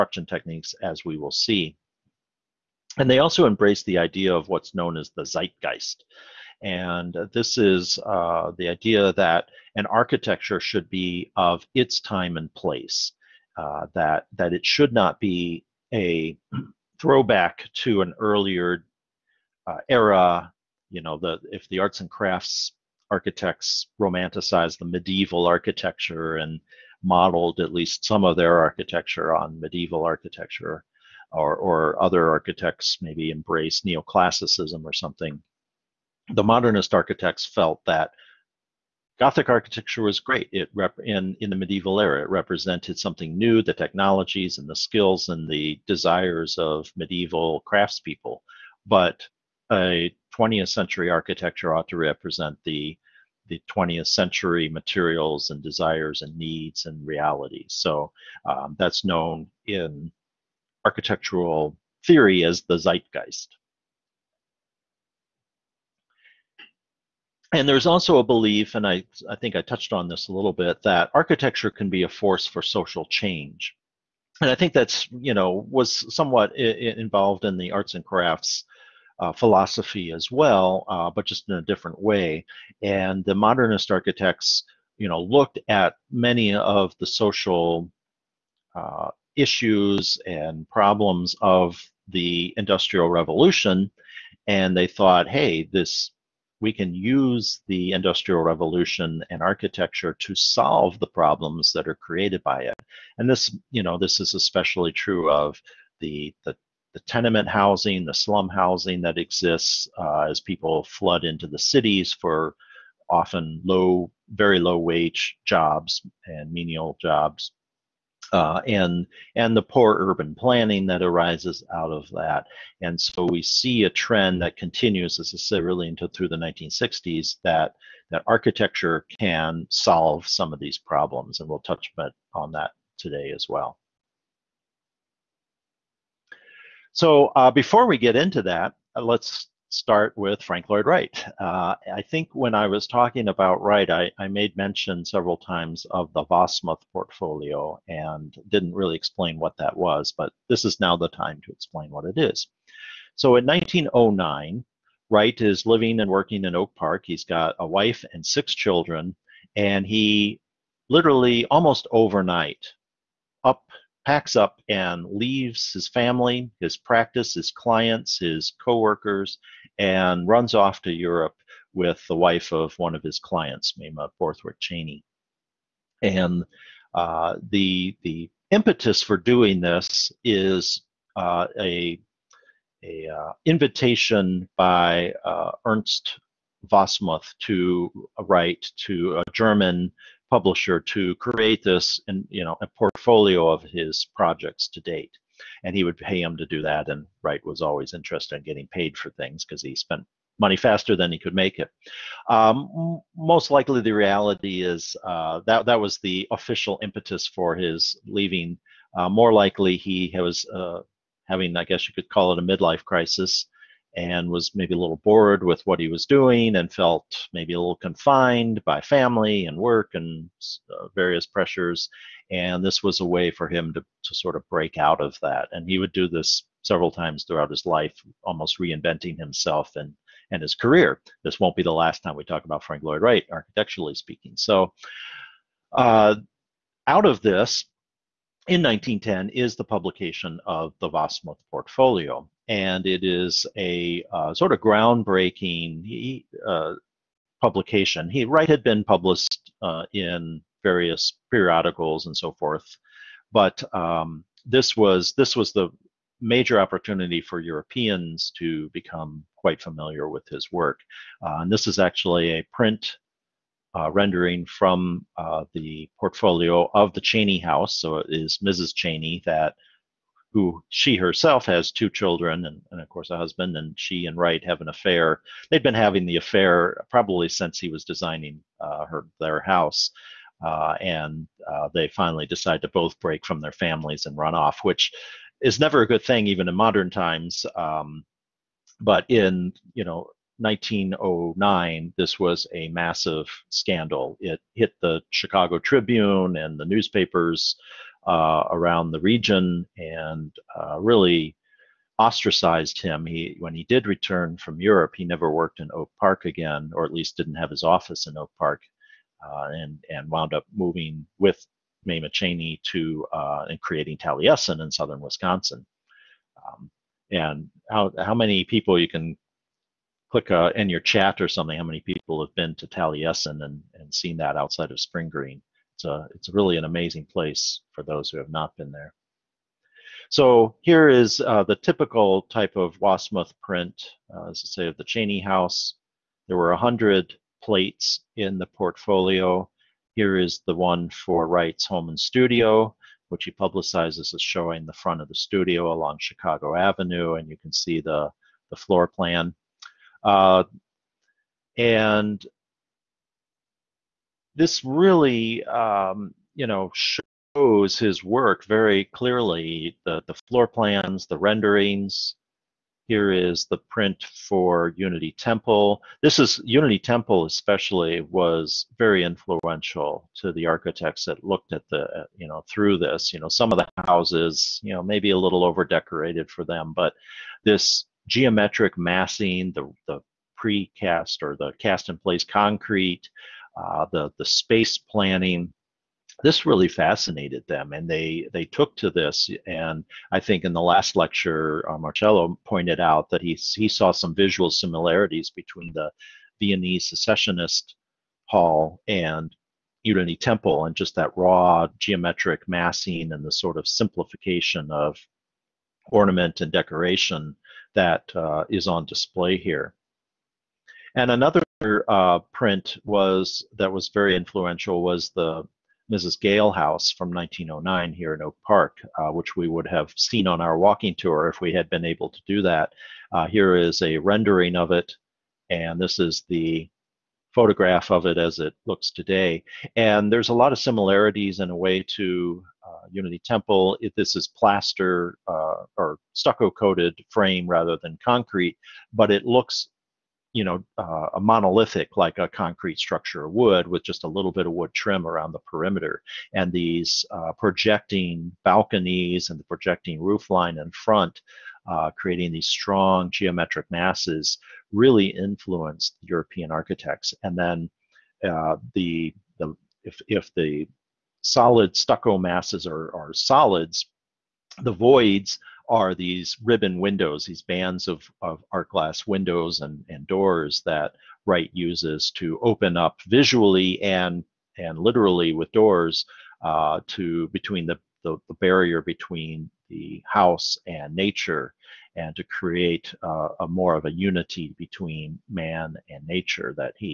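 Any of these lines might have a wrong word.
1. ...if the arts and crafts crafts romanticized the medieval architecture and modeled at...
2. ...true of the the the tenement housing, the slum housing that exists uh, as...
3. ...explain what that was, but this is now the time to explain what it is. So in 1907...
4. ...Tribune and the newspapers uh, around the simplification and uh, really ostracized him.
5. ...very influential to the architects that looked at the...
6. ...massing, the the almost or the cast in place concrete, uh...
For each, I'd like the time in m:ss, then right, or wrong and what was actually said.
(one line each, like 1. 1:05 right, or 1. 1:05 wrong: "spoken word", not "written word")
1. 0:21 wrong: "architects", not "crafts"
2. 1:44 right
3. 2:28 wrong: "1909", not "1907"
4. 4:55 wrong: "region", not "simplification"
5. 6:08 right
6. 6:18 wrong: "precast", not "almost".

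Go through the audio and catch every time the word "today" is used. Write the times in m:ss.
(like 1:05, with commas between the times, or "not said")
2:12, 7:08.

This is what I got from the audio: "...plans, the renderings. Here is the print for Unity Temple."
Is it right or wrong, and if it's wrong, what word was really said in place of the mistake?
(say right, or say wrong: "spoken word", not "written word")
right.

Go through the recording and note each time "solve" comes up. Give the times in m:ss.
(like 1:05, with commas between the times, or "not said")
1:40, 2:09.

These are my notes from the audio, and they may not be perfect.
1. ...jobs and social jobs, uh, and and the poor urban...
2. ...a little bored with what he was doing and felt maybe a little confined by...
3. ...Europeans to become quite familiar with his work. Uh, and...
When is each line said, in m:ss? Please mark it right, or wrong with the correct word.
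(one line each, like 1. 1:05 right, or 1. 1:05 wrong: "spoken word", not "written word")
1. 1:55 wrong: "menial", not "social"
2. 3:34 right
3. 4:17 right.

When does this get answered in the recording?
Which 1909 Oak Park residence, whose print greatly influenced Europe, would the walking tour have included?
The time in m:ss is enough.
6:55.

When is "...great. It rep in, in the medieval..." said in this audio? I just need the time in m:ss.
0:40.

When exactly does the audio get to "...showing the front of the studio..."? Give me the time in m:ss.
5:44.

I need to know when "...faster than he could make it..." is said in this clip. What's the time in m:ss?
3:20.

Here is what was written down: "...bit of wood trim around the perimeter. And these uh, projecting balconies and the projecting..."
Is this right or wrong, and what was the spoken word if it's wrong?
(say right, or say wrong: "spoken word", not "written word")
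right.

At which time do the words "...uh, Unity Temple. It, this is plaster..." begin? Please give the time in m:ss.
7:12.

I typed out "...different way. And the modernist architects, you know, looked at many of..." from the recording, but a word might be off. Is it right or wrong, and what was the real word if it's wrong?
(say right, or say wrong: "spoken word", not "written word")
right.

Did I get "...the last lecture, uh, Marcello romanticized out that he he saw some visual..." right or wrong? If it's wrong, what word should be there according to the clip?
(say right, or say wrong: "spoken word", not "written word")
wrong: "pointed", not "romanticized".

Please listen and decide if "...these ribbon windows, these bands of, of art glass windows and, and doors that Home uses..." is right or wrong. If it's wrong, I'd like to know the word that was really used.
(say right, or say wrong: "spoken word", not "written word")
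wrong: "Wright", not "Home".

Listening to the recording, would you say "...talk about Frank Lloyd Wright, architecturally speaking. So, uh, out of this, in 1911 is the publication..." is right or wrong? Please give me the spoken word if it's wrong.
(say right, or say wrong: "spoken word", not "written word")
wrong: "1910", not "1911".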